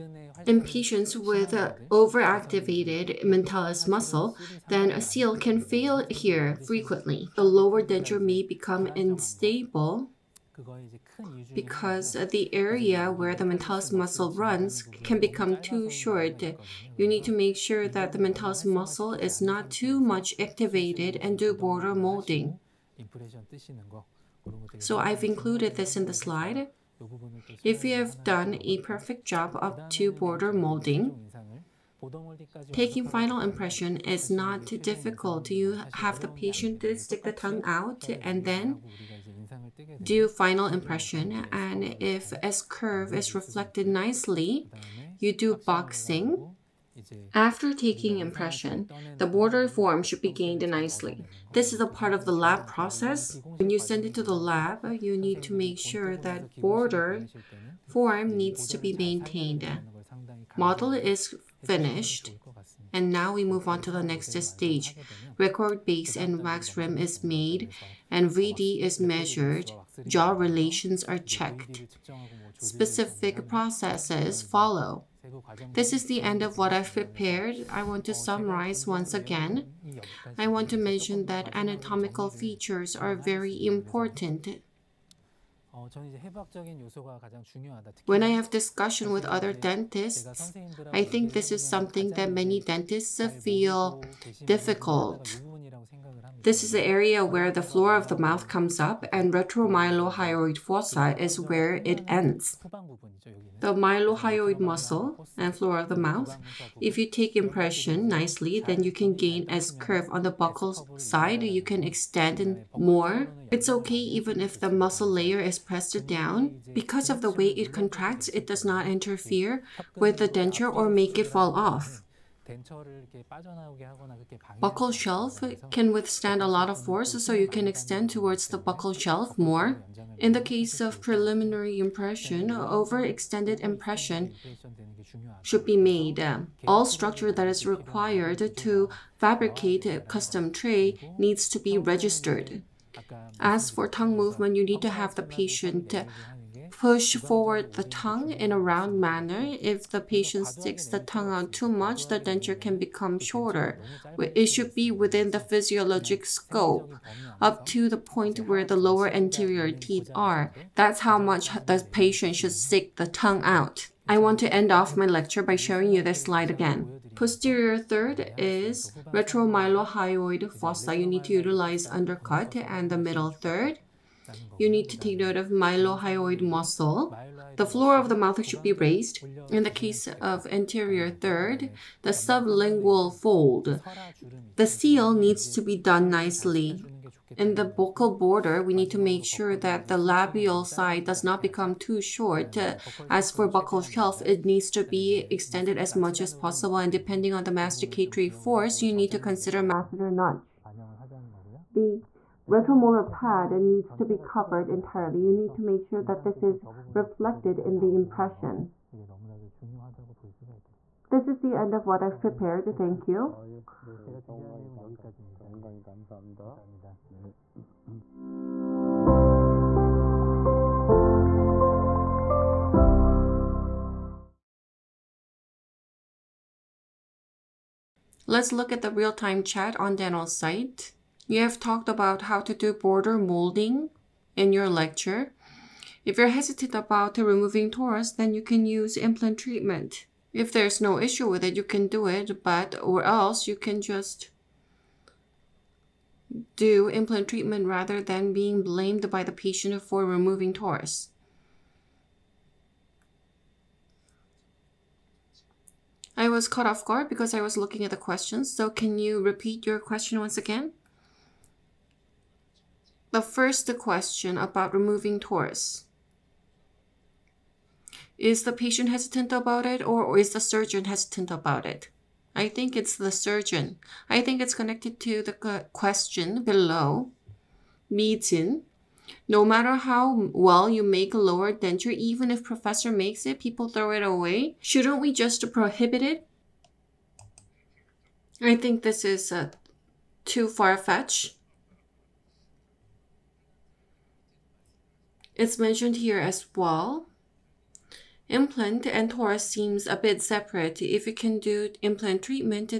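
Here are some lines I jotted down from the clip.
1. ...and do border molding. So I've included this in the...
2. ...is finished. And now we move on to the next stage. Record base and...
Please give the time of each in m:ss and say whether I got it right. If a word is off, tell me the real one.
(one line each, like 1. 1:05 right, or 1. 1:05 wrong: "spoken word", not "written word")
1. 0:21 right
2. 1:00 right.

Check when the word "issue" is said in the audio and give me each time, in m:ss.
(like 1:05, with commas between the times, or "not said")
4:00.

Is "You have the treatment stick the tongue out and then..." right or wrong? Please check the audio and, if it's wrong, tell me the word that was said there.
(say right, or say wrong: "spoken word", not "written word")
wrong: "patient", not "treatment".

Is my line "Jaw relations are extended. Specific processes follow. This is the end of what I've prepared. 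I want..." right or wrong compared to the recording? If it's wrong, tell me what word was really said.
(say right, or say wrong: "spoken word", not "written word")
wrong: "checked", not "extended".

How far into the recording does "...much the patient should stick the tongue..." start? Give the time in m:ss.
2:41.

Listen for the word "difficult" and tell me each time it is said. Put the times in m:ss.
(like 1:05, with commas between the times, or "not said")
0:34, 1:34.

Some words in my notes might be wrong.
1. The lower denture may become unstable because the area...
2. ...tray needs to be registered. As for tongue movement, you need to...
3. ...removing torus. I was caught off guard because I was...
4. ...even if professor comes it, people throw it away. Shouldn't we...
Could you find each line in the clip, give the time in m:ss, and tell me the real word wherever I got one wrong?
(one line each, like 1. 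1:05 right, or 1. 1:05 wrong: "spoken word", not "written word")
1. 0:07 right
2. 2:20 right
3. 4:10 right
4. 4:41 wrong: "makes", not "comes".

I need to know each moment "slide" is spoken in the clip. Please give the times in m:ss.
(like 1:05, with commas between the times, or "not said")
0:26, 2:46.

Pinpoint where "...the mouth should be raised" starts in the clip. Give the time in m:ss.
2:58.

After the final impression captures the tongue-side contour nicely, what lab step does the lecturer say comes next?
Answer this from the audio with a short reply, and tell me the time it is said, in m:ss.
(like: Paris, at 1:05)
boxing, at 0:45.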